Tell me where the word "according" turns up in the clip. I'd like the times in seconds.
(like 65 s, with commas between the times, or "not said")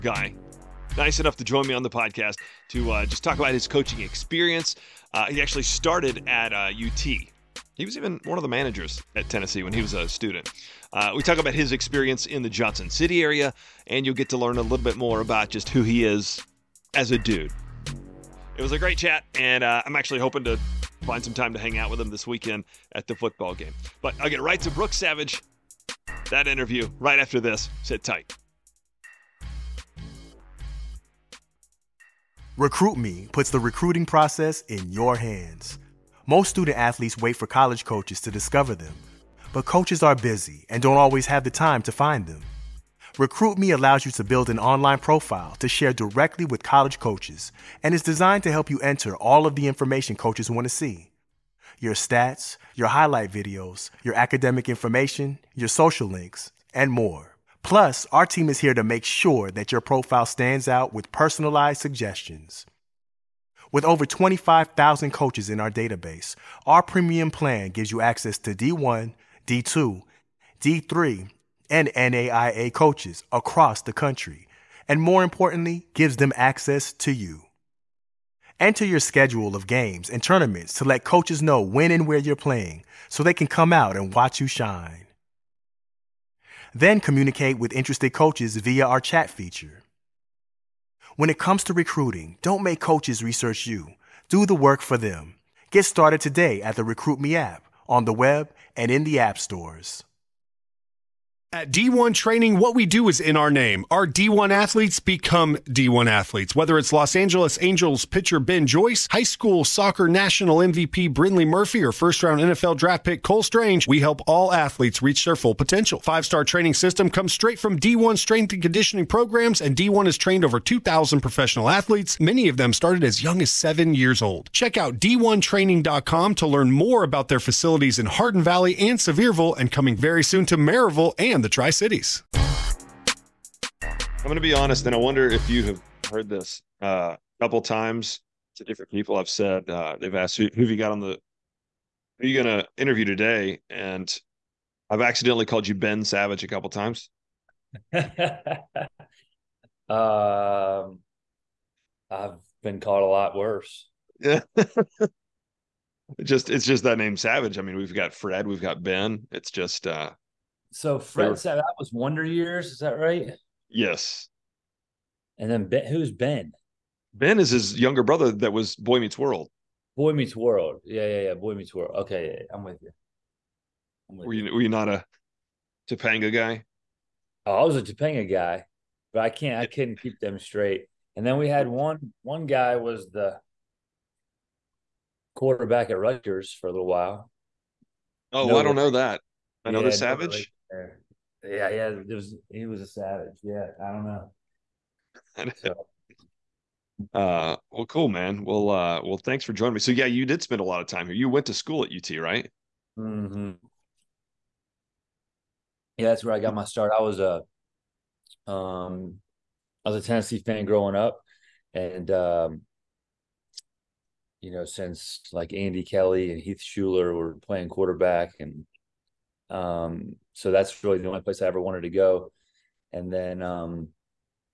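not said.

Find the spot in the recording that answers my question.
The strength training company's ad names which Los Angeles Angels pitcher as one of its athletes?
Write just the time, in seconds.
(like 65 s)
108 s.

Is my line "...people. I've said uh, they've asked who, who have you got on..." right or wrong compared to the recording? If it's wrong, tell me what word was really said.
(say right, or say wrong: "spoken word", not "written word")
right.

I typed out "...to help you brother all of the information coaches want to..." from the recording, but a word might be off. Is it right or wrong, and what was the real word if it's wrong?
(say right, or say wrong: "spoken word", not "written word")
wrong: "enter", not "brother".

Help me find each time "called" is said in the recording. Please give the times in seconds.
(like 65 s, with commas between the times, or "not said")
145 s, 152 s.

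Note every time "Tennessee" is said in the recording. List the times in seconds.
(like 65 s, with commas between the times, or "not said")
9 s, 210 s.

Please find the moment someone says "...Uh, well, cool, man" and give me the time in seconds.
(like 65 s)
197 s.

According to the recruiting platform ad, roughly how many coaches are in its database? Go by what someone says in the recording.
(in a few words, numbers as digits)
25,000.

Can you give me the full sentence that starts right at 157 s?
I mean, we've got Fred, we've got Ben.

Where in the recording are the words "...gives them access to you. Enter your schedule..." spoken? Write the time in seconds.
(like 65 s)
75 s.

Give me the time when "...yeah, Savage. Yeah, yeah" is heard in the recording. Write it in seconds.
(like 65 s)
189 s.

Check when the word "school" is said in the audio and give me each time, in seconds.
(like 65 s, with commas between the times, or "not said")
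109 s, 201 s.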